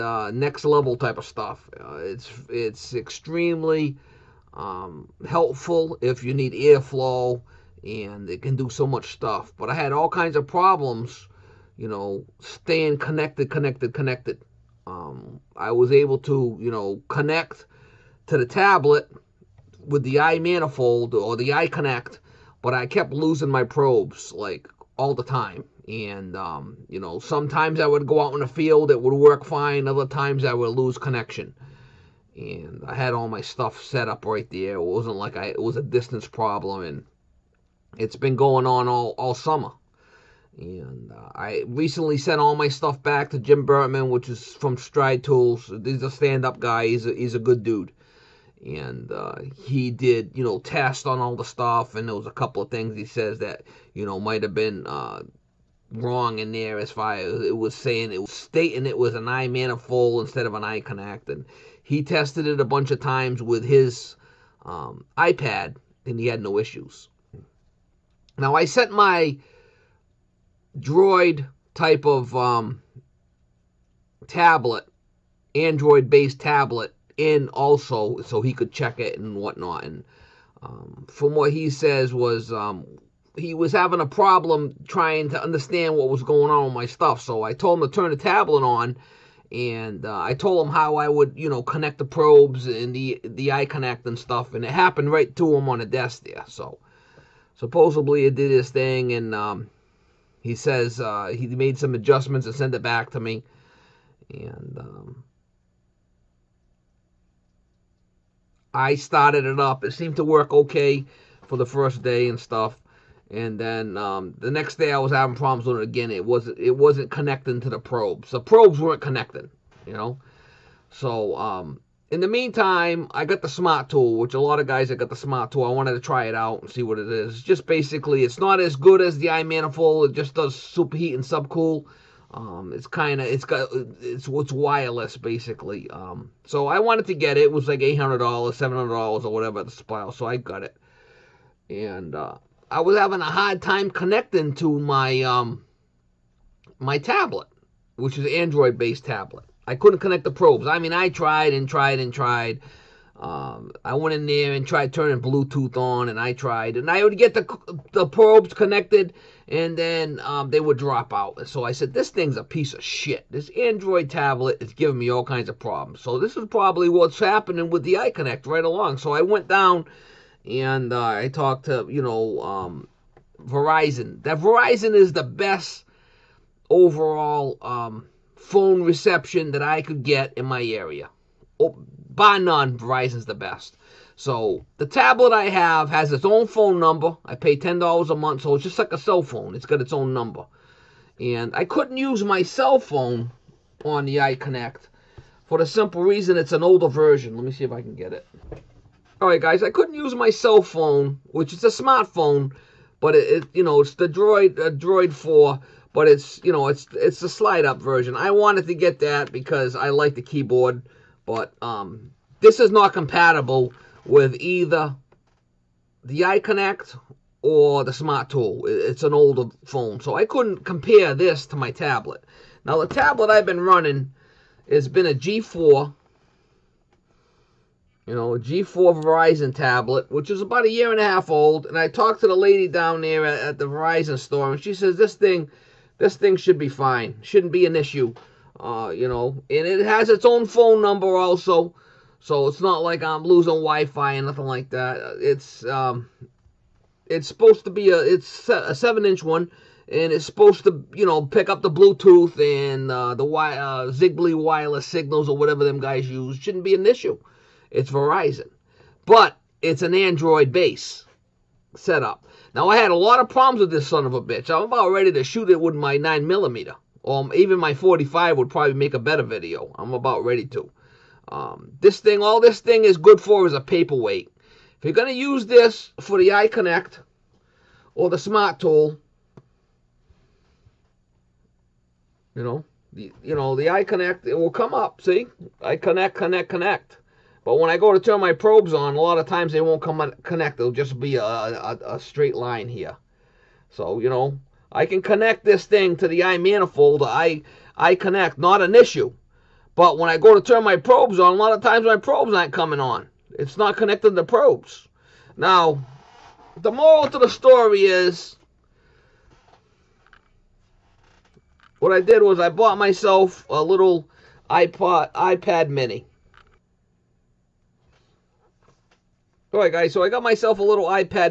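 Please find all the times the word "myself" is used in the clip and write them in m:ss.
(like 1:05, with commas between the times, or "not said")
5:12, 5:20.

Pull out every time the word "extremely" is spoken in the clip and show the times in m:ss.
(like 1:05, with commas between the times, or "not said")
0:02.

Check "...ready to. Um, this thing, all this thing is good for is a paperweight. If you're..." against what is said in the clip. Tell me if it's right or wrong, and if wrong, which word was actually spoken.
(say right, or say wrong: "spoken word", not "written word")
right.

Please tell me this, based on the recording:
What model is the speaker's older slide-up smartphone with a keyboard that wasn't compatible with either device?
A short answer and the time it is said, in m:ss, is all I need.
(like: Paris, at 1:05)
Droid 4, at 3:24.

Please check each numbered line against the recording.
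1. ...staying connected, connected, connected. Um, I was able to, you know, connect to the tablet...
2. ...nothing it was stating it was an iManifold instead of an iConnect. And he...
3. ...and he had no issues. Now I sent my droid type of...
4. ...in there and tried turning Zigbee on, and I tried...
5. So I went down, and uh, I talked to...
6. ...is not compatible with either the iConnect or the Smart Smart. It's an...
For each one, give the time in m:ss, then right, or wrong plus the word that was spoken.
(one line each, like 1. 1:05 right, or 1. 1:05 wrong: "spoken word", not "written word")
1. 0:12 right
2. 0:57 wrong: "saying", not "nothing"
3. 1:06 right
4. 2:34 wrong: "Bluetooth", not "Zigbee"
5. 2:48 right
6. 3:32 wrong: "Tool", not "Smart".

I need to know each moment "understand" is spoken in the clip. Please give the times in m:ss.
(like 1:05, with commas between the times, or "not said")
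1:25.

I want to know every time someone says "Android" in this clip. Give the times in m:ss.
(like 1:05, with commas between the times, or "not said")
1:15, 2:28, 2:43, 4:19.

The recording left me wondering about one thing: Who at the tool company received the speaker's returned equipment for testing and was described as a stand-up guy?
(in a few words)
Jim Burtman.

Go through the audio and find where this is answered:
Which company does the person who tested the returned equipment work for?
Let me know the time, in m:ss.
0:44.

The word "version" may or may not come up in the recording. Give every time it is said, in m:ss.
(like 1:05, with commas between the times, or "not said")
3:16, 3:27.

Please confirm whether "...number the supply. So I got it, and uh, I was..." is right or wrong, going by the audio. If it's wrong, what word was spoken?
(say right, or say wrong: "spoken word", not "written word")
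wrong: "whatever", not "number".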